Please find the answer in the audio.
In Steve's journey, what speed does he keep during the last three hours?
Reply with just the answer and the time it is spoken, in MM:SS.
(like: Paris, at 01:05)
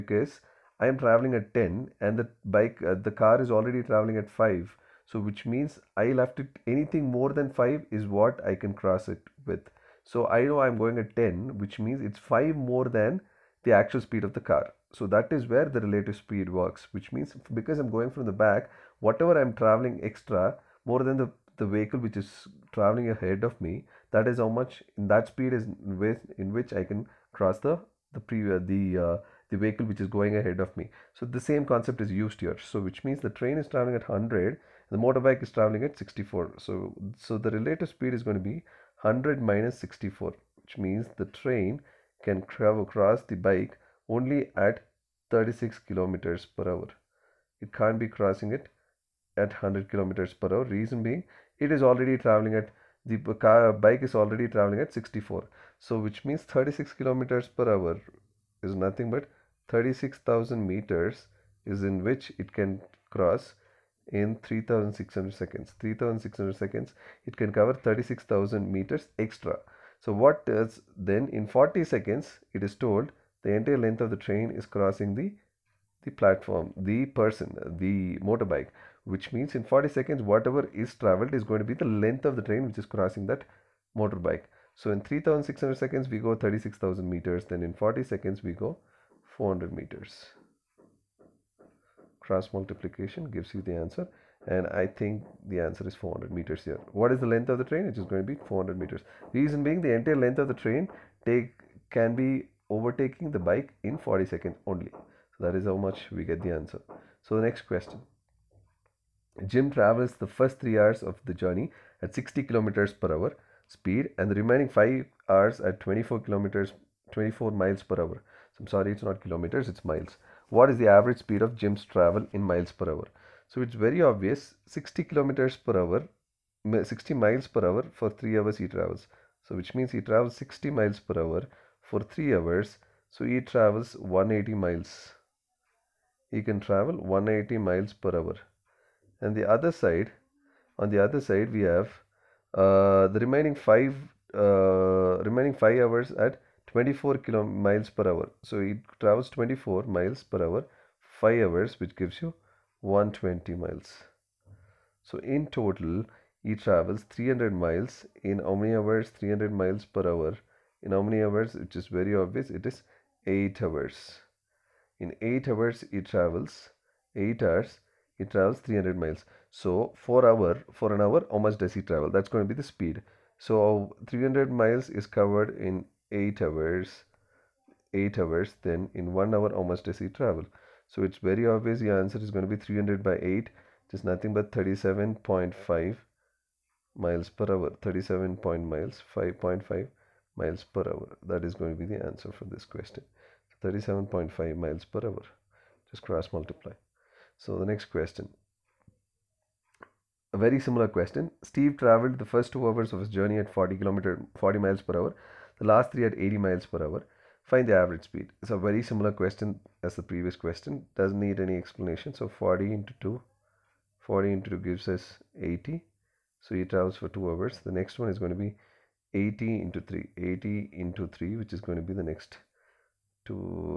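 80 miles per hour, at 03:26.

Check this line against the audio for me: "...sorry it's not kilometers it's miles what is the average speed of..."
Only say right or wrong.
right.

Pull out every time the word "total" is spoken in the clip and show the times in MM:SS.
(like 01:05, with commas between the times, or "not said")
02:35.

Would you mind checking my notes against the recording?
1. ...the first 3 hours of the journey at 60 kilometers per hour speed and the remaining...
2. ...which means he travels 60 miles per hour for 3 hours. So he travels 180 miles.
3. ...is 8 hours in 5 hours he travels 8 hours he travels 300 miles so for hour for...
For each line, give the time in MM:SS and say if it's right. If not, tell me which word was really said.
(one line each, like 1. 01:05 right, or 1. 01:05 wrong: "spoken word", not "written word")
1. 01:50 right
2. 02:09 right
3. 02:42 wrong: "8", not "5".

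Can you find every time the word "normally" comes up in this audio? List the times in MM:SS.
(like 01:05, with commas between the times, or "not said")
not said.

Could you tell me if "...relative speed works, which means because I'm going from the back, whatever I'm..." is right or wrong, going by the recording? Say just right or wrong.
right.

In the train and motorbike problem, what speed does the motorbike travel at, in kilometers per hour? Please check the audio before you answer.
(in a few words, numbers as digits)
64.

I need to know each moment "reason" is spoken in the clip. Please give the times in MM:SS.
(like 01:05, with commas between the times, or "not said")
00:50, 01:39.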